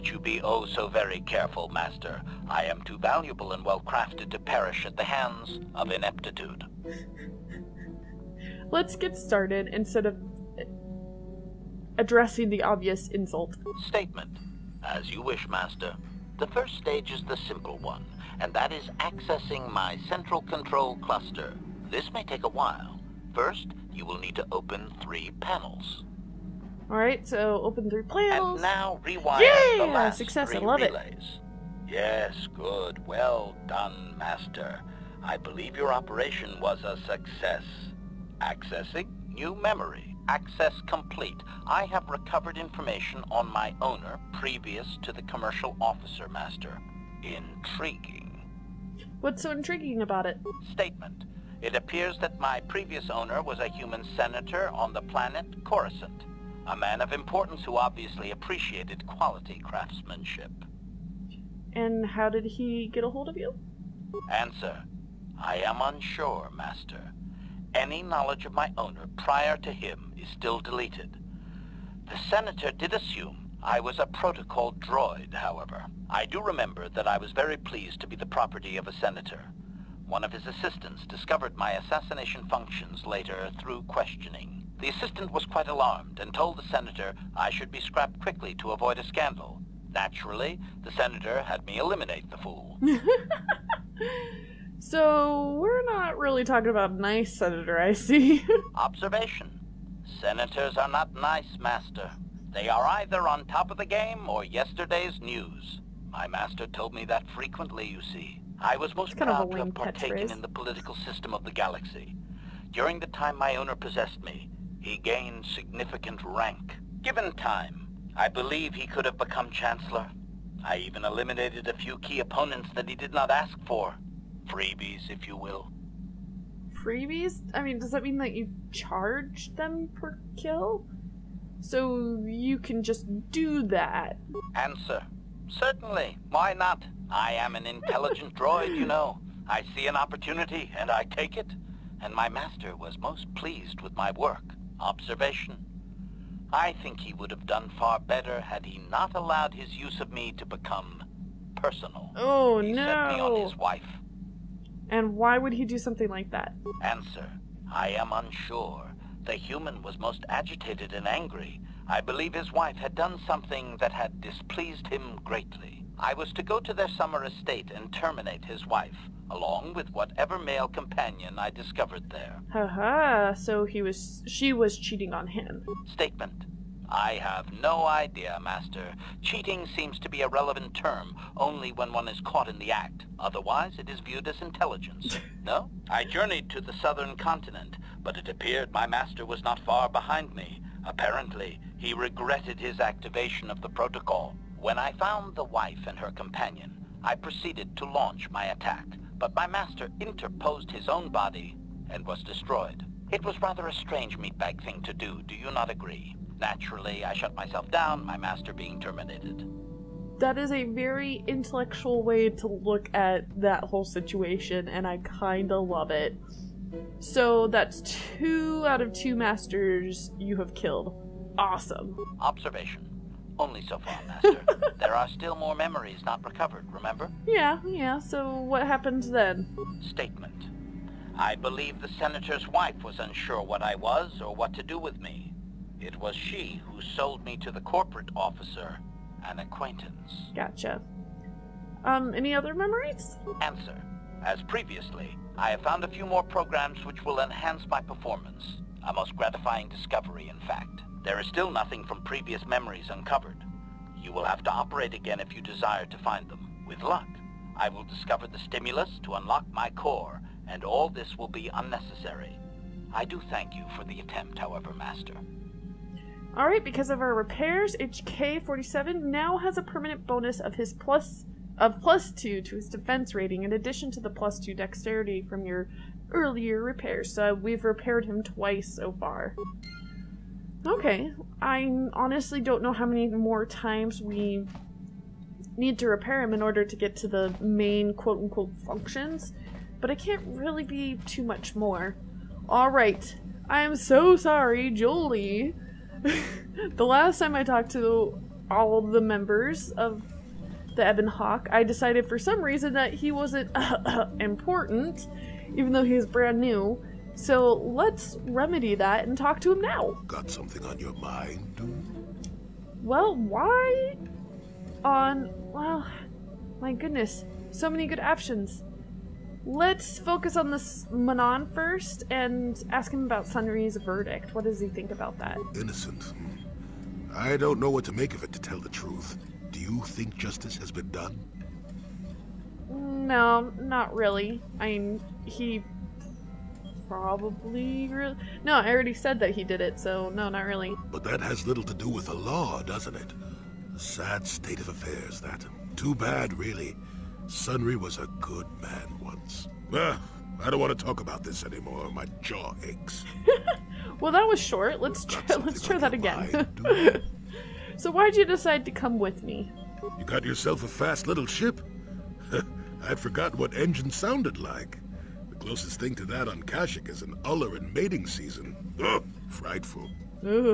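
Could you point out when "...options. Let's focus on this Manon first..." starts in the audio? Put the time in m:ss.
5:18.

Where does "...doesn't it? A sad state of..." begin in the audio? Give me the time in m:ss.
5:42.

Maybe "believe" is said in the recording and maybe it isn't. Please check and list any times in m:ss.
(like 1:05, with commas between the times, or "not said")
0:35, 1:58, 2:42, 3:51.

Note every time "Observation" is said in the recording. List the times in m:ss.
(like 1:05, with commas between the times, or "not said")
1:38, 2:24, 3:42.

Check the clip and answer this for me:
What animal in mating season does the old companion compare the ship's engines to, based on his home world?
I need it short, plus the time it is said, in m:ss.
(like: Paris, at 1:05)
An uller, at 6:07.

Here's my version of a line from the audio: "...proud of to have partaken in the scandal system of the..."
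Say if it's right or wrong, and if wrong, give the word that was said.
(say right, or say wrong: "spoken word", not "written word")
wrong: "political", not "scandal".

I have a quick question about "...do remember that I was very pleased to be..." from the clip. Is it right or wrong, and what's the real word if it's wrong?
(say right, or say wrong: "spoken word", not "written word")
right.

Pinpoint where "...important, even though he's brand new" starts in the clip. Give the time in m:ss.
5:04.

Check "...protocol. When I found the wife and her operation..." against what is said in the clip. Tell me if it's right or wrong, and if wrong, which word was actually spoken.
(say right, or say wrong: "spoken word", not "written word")
wrong: "companion", not "operation".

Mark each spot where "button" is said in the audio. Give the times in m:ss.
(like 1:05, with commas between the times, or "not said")
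not said.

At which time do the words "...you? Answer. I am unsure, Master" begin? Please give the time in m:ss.
1:03.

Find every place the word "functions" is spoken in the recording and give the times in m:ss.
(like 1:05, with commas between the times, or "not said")
1:22, 4:48.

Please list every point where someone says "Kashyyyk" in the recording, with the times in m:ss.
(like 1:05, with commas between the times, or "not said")
6:06.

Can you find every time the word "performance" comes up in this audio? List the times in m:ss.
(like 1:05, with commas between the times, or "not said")
4:07.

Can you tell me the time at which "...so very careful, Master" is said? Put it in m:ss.
0:00.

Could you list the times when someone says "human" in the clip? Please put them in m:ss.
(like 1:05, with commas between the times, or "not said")
0:53, 2:39.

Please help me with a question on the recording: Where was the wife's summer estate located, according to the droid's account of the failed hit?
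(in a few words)
The southern continent.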